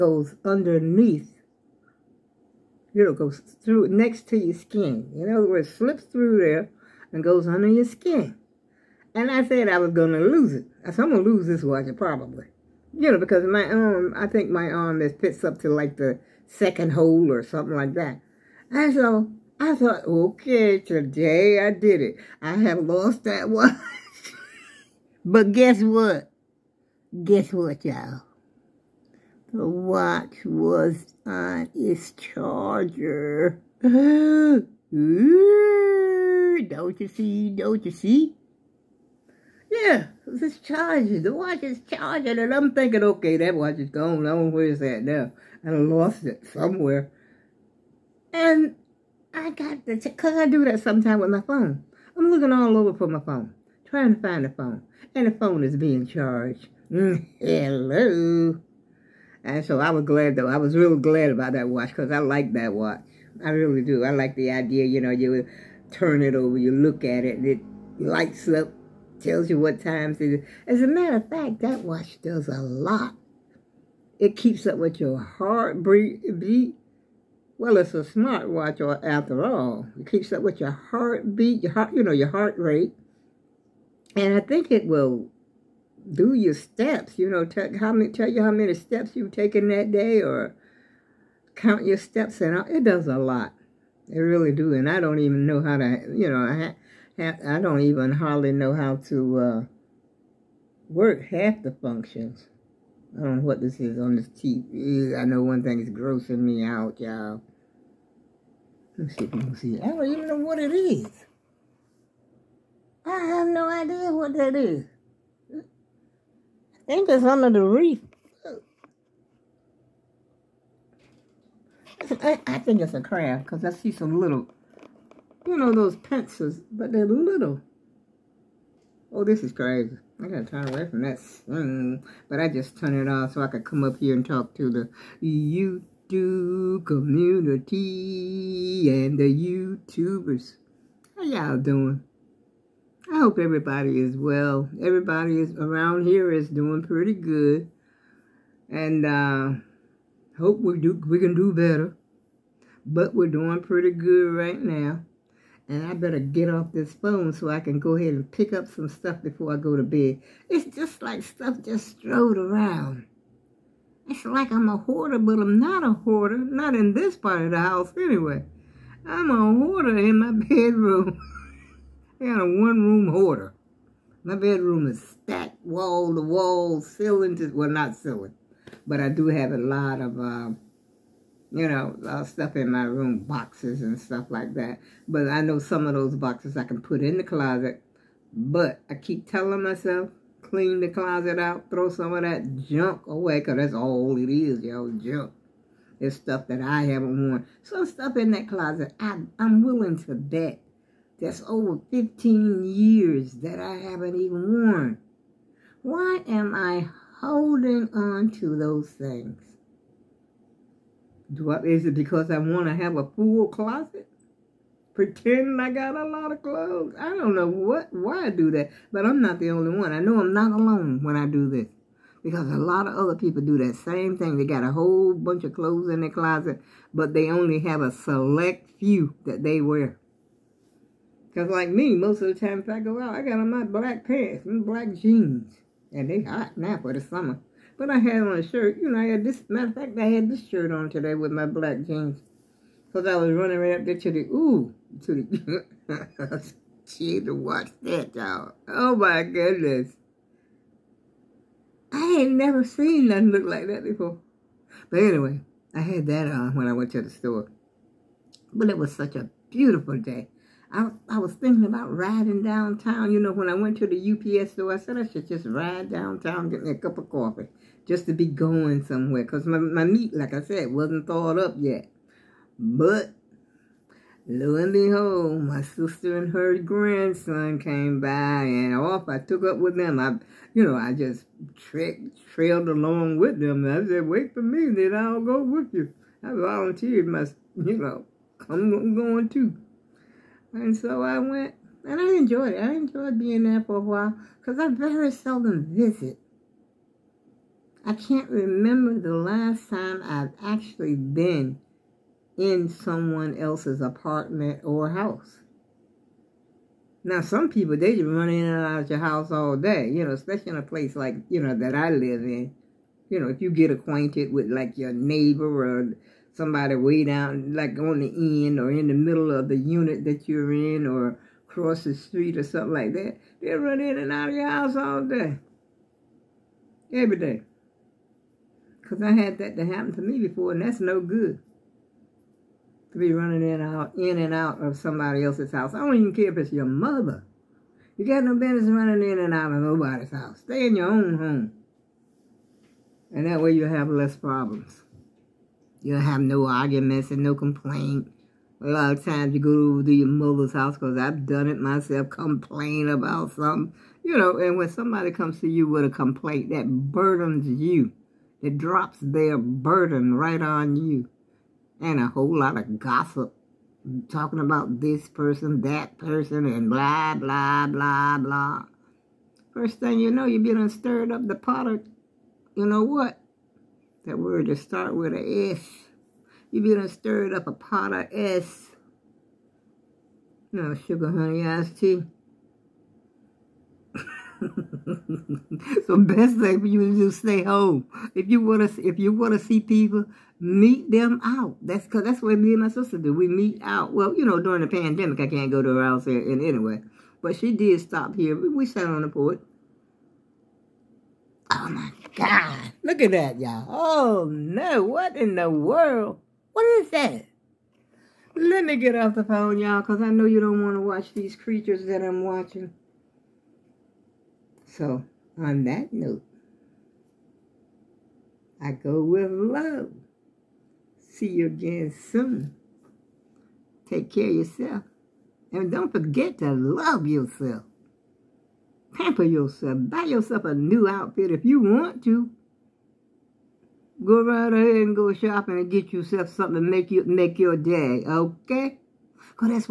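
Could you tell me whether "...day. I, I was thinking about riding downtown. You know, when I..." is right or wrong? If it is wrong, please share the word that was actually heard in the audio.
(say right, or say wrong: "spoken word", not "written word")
right.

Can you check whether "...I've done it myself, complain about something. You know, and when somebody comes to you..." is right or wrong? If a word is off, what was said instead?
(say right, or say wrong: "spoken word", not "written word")
right.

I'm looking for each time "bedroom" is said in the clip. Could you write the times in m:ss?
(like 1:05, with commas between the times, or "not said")
2:50, 2:54.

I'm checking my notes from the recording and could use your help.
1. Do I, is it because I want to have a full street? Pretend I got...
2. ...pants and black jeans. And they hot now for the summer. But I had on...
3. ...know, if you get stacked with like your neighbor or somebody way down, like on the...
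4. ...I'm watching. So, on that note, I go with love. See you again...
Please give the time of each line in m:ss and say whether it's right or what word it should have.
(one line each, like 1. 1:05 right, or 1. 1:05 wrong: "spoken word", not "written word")
1. 3:31 wrong: "closet", not "street"
2. 3:54 right
3. 5:13 wrong: "acquainted", not "stacked"
4. 6:52 right.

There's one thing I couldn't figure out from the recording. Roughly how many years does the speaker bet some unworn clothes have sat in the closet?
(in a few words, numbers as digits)
Over 15 years.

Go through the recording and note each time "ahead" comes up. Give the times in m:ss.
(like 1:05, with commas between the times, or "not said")
2:37, 7:14.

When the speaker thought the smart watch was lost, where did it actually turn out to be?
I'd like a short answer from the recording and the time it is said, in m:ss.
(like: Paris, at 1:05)
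On its charger, at 0:30.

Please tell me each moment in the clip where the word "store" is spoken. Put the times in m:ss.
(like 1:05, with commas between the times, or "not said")
4:17, 4:24.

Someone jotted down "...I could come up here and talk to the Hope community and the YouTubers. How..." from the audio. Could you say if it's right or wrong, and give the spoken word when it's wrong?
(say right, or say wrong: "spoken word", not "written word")
wrong: "YouTube", not "Hope".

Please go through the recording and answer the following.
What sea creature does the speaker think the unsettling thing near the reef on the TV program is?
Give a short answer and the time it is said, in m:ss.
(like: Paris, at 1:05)
A crab, at 2:02.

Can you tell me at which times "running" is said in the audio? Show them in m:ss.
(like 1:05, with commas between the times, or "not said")
4:03, 5:33, 5:38.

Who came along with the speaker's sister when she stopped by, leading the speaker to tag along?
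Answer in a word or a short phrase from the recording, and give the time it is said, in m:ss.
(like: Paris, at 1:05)
Her grandson, at 4:36.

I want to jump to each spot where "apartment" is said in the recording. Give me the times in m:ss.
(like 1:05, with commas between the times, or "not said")
5:03.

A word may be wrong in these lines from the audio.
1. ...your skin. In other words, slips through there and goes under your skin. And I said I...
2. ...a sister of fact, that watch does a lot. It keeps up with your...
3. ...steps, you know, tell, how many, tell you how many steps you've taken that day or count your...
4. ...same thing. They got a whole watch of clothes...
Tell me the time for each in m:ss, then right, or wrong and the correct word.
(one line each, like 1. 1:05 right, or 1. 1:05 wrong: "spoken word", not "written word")
1. 0:04 right
2. 1:10 wrong: "matter", not "sister"
3. 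1:26 right
4. 3:43 wrong: "bunch", not "watch".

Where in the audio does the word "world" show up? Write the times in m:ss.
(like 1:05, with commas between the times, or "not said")
6:45.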